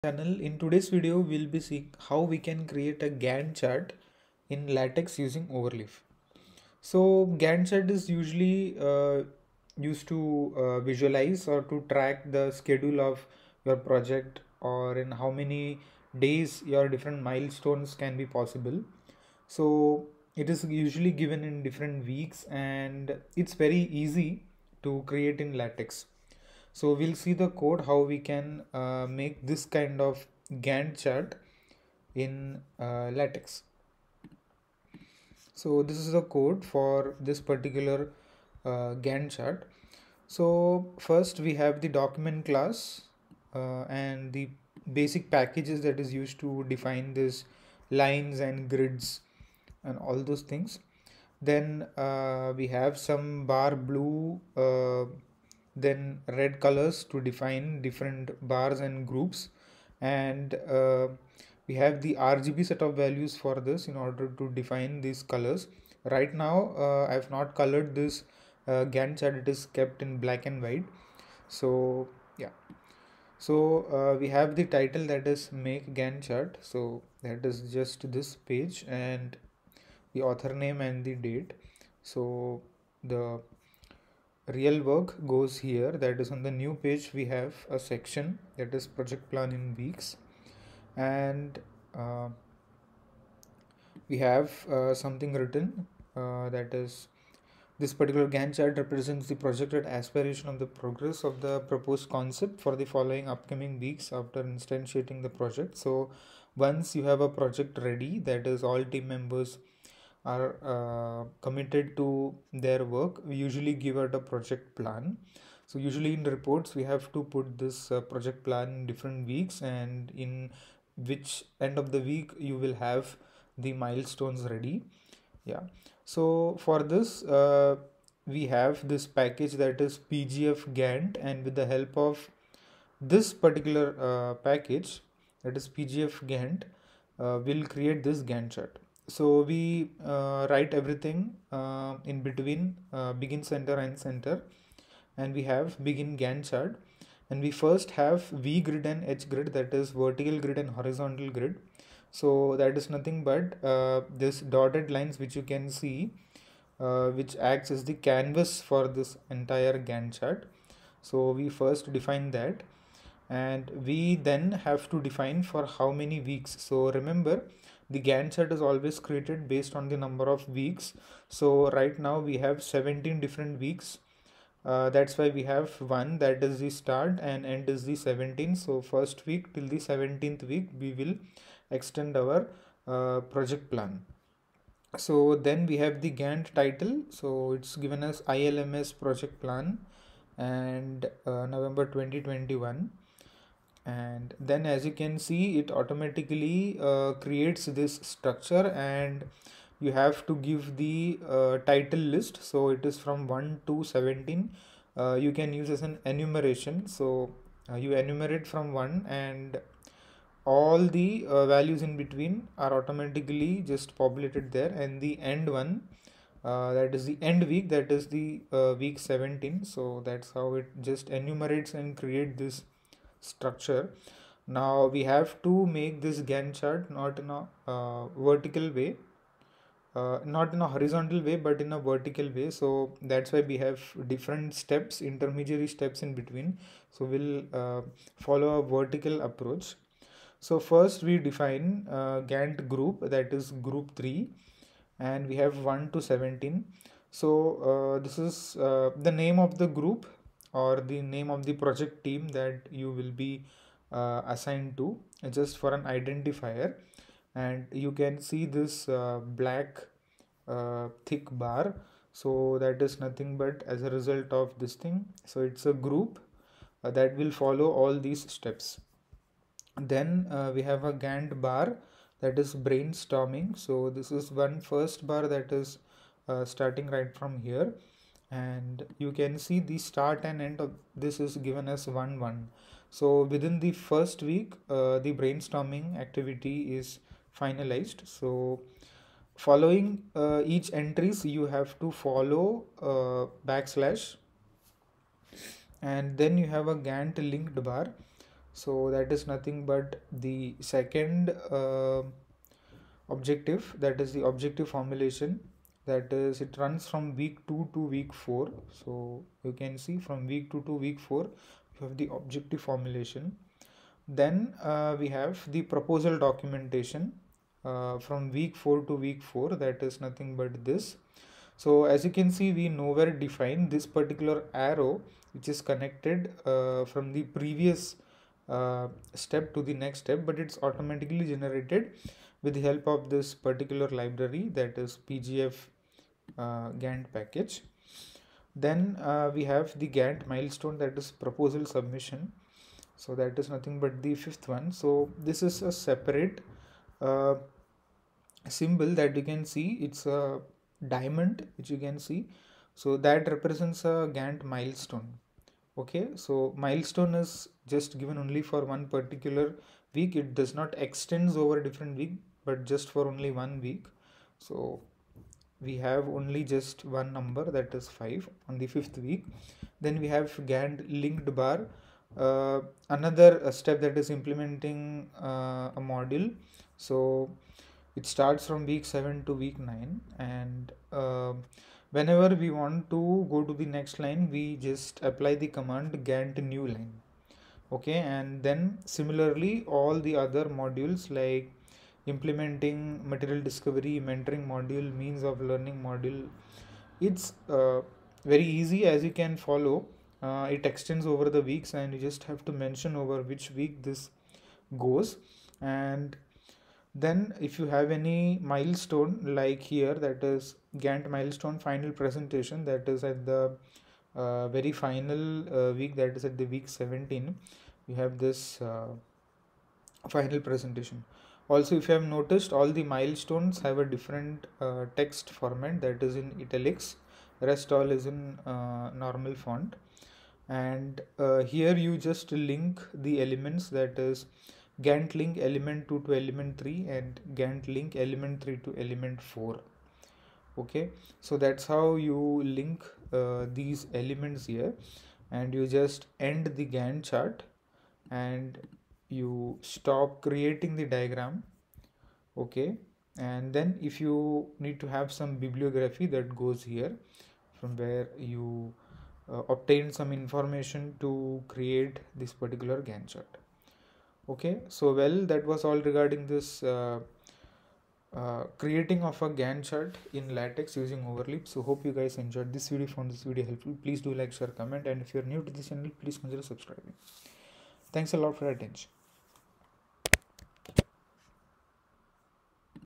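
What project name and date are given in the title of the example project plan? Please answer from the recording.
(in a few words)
ILMS project plan, November 2021.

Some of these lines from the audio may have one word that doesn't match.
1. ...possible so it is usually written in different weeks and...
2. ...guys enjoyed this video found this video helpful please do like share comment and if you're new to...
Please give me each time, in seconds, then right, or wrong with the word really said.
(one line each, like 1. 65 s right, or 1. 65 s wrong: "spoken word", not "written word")
1. 18 s wrong: "given", not "written"
2. 471 s right.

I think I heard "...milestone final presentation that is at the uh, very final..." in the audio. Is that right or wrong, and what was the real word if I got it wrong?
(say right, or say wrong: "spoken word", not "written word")
right.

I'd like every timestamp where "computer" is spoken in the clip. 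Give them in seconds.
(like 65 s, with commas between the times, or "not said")
not said.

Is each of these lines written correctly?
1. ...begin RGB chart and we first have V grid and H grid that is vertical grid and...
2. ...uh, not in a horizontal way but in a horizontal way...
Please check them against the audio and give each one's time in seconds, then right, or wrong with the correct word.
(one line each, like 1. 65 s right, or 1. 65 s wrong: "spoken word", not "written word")
1. 145 s wrong: "Gantt", not "RGB"
2. 229 s wrong: "vertical", not "horizontal".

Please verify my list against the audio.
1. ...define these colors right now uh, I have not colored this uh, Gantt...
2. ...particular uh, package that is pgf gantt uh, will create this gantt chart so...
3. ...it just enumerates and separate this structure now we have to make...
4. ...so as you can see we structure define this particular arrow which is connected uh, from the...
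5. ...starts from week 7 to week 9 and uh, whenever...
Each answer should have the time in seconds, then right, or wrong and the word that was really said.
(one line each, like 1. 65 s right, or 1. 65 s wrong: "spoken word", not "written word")
1. 64 s right
2. 133 s right
3. 220 s wrong: "create", not "separate"
4. 321 s wrong: "nowhere", not "structure"
5. 378 s right.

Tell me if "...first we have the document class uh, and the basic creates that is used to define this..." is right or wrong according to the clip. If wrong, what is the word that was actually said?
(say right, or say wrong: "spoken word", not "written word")
wrong: "packages", not "creates".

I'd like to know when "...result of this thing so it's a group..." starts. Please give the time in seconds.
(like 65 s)
263 s.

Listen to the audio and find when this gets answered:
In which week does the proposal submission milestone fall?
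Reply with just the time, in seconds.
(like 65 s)
368 s.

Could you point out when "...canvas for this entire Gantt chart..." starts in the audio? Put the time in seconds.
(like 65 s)
157 s.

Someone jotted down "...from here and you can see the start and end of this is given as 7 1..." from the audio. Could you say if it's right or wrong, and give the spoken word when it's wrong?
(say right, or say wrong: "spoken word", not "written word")
wrong: "1", not "7".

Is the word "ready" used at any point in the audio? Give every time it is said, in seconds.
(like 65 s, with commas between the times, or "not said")
107 s, 124 s.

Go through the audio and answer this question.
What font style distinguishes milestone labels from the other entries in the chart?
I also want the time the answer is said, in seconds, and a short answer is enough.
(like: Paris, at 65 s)
Italics, at 426 s.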